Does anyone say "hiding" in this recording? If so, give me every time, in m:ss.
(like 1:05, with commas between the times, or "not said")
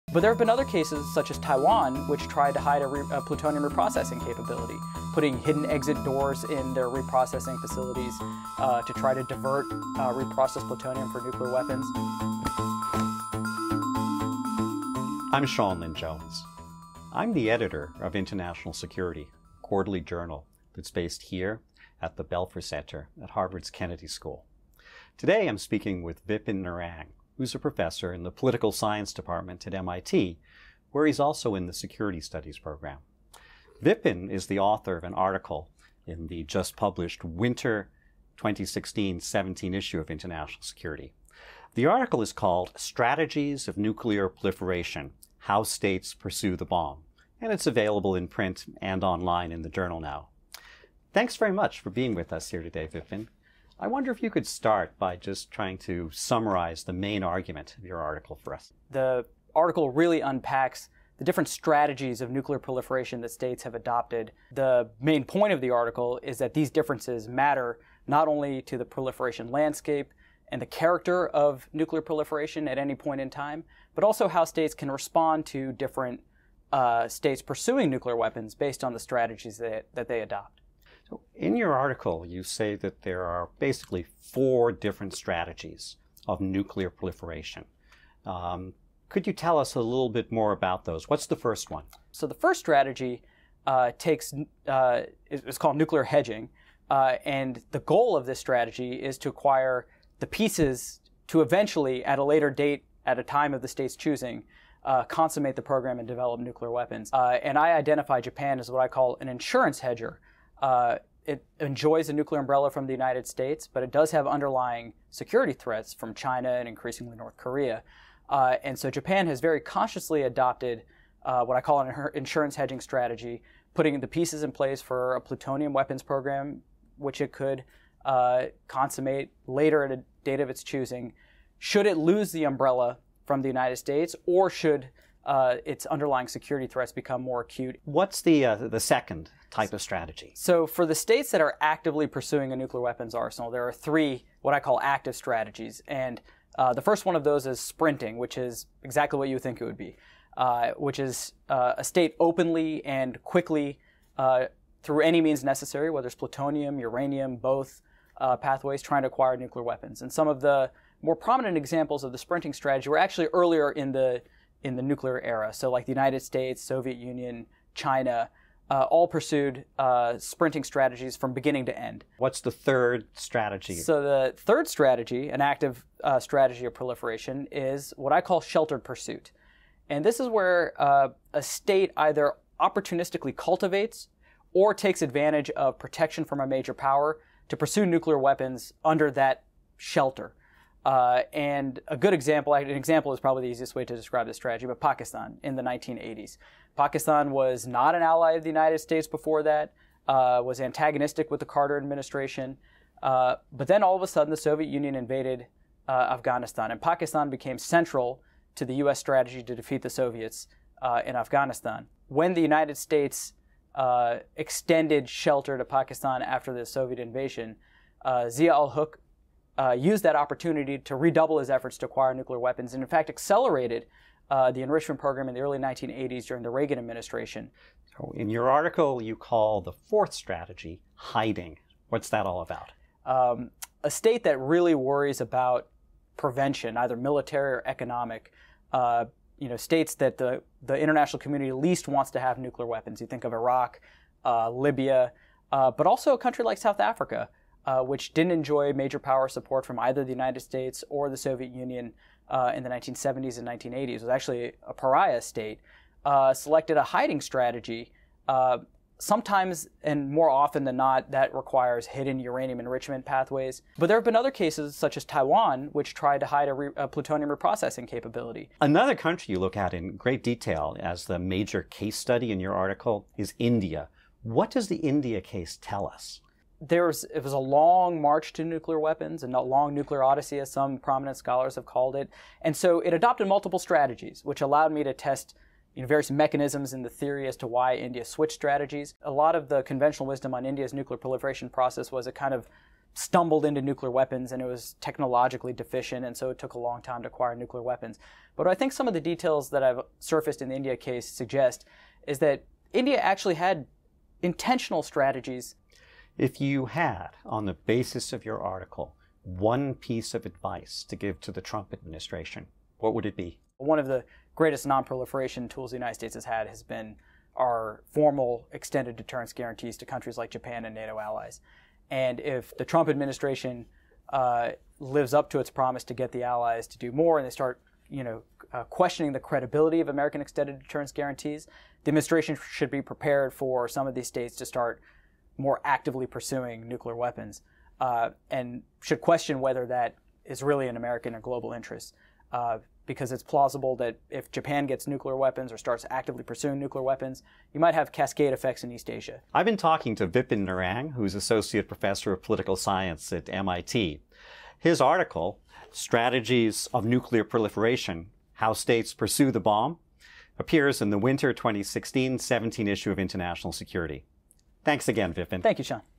3:50, 4:16.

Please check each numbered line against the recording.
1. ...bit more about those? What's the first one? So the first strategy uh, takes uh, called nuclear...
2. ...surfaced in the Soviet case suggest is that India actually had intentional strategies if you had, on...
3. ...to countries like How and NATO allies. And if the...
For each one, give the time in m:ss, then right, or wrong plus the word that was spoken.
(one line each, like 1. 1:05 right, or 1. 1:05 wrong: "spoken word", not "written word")
1. 1:30 right
2. 4:59 wrong: "India", not "Soviet"
3. 5:19 wrong: "Japan", not "How".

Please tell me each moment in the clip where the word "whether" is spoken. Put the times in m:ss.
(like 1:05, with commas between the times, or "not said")
2:35, 5:39.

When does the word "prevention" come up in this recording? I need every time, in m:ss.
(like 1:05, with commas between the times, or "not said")
3:56.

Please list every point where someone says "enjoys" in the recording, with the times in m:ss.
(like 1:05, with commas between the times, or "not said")
1:51, 4:08.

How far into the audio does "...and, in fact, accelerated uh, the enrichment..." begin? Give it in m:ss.
3:42.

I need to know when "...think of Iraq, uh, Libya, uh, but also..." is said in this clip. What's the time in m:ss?
4:03.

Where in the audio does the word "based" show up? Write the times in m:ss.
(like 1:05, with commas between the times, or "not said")
0:20, 1:18.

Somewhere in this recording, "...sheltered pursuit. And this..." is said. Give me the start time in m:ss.
2:58.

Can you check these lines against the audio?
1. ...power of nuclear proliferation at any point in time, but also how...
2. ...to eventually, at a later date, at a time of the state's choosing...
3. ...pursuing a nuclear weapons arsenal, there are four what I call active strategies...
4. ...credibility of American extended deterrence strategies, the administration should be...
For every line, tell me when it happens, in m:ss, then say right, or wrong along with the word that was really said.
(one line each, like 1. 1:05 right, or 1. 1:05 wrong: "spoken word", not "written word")
1. 1:10 wrong: "character", not "power"
2. 1:41 right
3. 2:22 wrong: "three", not "four"
4. 5:29 wrong: "guarantees", not "strategies".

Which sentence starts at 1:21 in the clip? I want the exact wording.
So in your article, you say that there are basically four different strategies of nuclear proliferation.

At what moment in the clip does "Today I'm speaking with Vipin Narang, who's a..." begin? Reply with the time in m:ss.
0:25.